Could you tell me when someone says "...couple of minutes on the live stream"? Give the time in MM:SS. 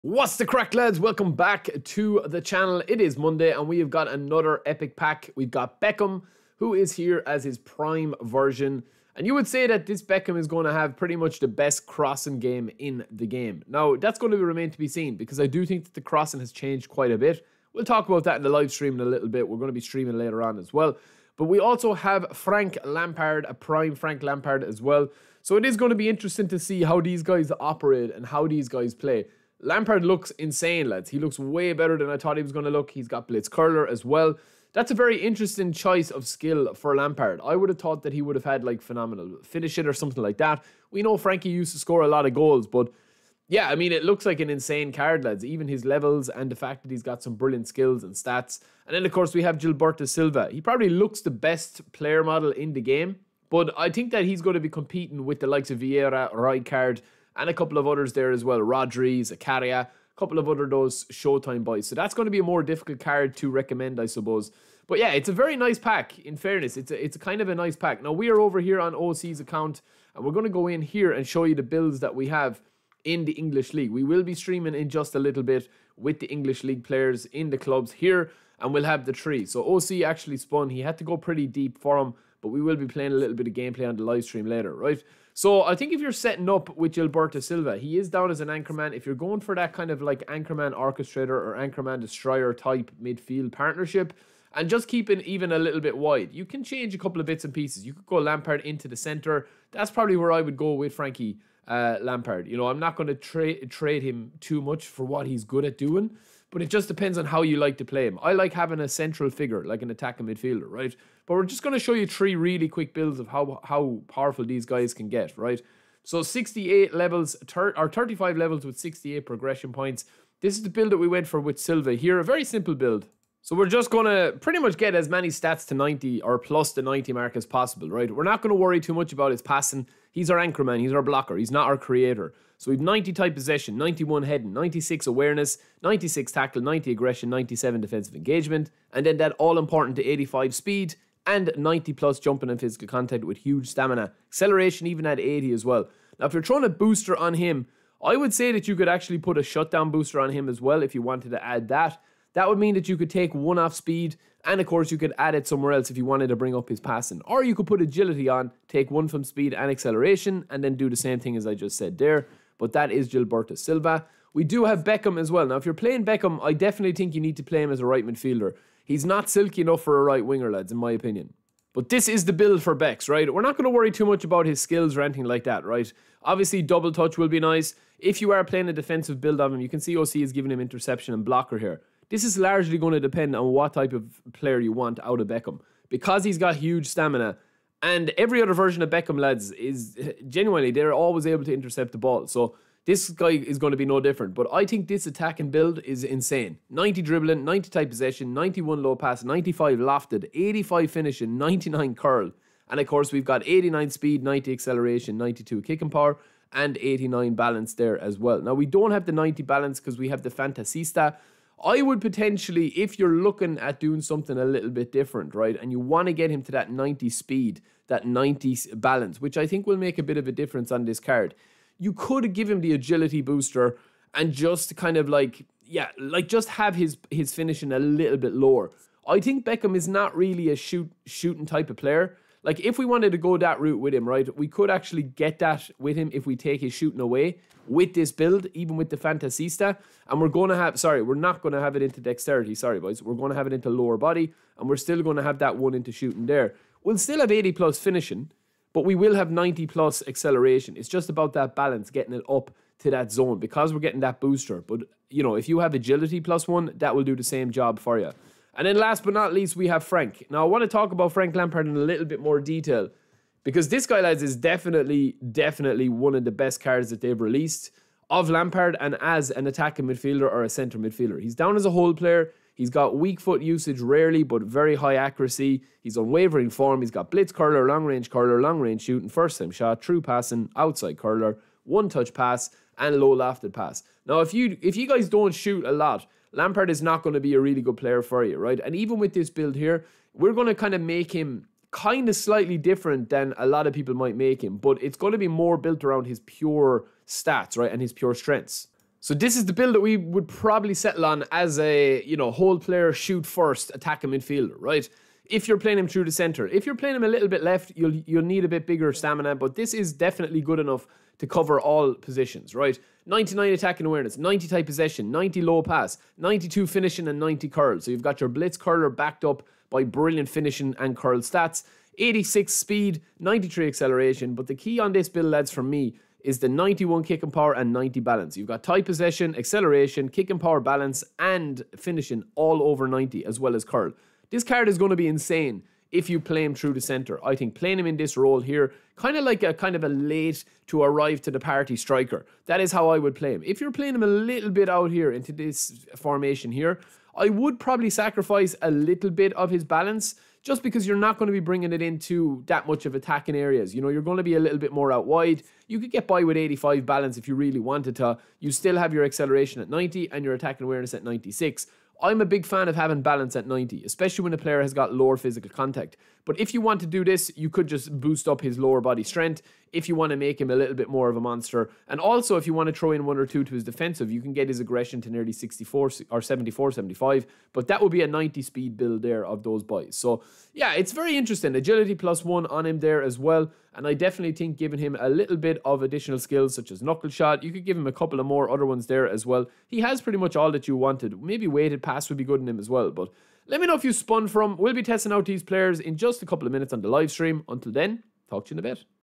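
06:36.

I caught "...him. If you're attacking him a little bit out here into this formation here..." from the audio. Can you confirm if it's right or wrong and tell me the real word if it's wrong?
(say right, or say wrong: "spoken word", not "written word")
wrong: "playing", not "attacking".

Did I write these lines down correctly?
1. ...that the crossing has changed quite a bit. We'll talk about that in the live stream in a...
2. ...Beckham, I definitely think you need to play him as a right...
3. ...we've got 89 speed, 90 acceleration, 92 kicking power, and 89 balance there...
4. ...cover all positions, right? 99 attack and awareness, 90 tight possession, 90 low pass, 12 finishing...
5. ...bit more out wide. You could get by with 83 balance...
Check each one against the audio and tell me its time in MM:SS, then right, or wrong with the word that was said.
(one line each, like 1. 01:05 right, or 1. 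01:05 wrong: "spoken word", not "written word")
1. 00:15 right
2. 02:46 right
3. 03:23 right
4. 05:11 wrong: "92", not "12"
5. 05:54 wrong: "85", not "83".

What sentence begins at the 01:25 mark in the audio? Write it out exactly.
So I think if you're setting up with Gilberto Silva, he is down as an anchorman.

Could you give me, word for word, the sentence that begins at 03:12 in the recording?
So this guy is going to be no different.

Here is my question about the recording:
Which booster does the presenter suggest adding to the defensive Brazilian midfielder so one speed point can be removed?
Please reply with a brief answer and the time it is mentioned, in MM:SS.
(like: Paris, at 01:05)
shutdown, at 02:29.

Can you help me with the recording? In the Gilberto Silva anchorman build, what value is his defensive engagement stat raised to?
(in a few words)
97.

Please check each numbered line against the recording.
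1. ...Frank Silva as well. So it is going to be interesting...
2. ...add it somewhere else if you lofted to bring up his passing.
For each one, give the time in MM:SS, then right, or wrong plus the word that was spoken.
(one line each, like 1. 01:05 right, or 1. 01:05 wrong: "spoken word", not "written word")
1. 00:23 wrong: "Lampard", not "Silva"
2. 02:35 wrong: "wanted", not "lofted".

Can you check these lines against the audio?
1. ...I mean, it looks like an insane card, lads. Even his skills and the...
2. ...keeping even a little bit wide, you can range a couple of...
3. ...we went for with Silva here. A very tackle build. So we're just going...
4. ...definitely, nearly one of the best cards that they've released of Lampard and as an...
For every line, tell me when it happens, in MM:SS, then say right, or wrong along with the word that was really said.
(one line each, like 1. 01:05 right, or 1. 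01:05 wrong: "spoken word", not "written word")
1. 00:43 wrong: "levels", not "skills"
2. 01:34 wrong: "change", not "range"
3. 02:00 wrong: "simple", not "tackle"
4. 04:24 wrong: "definitely", not "nearly".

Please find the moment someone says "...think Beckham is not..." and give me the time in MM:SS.
03:49.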